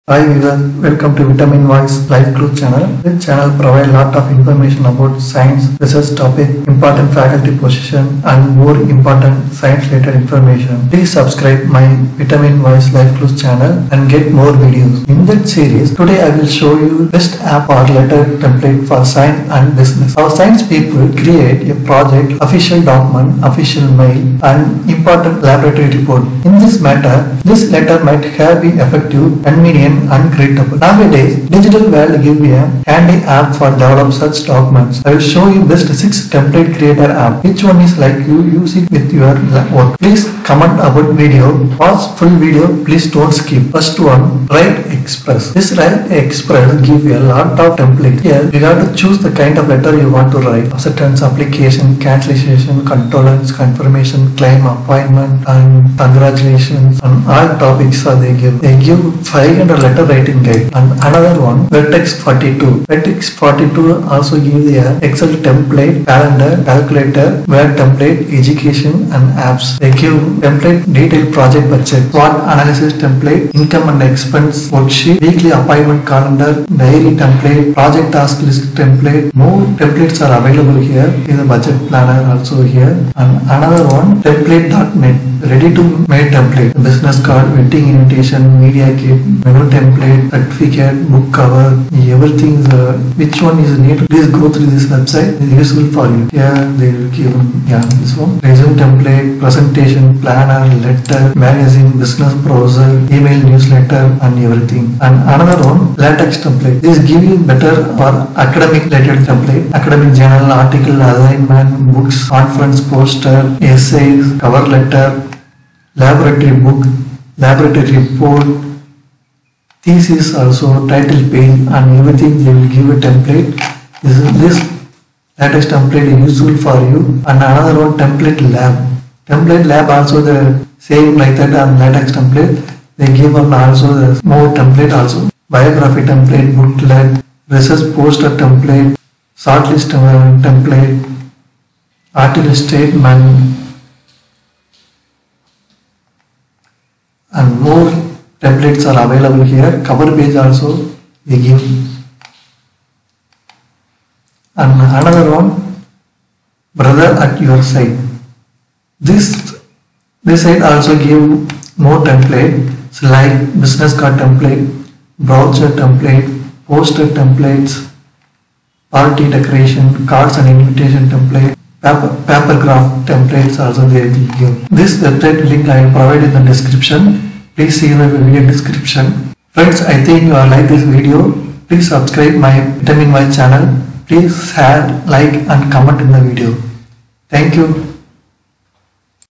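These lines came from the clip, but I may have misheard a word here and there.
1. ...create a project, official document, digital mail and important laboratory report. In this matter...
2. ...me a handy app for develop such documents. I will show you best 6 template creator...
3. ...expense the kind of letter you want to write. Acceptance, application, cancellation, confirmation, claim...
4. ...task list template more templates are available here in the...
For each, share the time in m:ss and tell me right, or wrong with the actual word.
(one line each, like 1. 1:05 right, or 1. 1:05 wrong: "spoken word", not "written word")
1. 0:21 wrong: "official", not "digital"
2. 0:32 right
3. 0:48 wrong: "choose", not "expense"
4. 1:18 right.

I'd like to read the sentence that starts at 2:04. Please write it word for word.
This is this latex template useful for you and another one template lab.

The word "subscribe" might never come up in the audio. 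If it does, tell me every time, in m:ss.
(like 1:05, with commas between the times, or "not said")
0:11, 3:01.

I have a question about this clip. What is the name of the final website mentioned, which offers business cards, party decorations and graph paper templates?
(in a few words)
Brother at Your Side.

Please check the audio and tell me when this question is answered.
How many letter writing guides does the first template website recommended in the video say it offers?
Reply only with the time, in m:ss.
0:59.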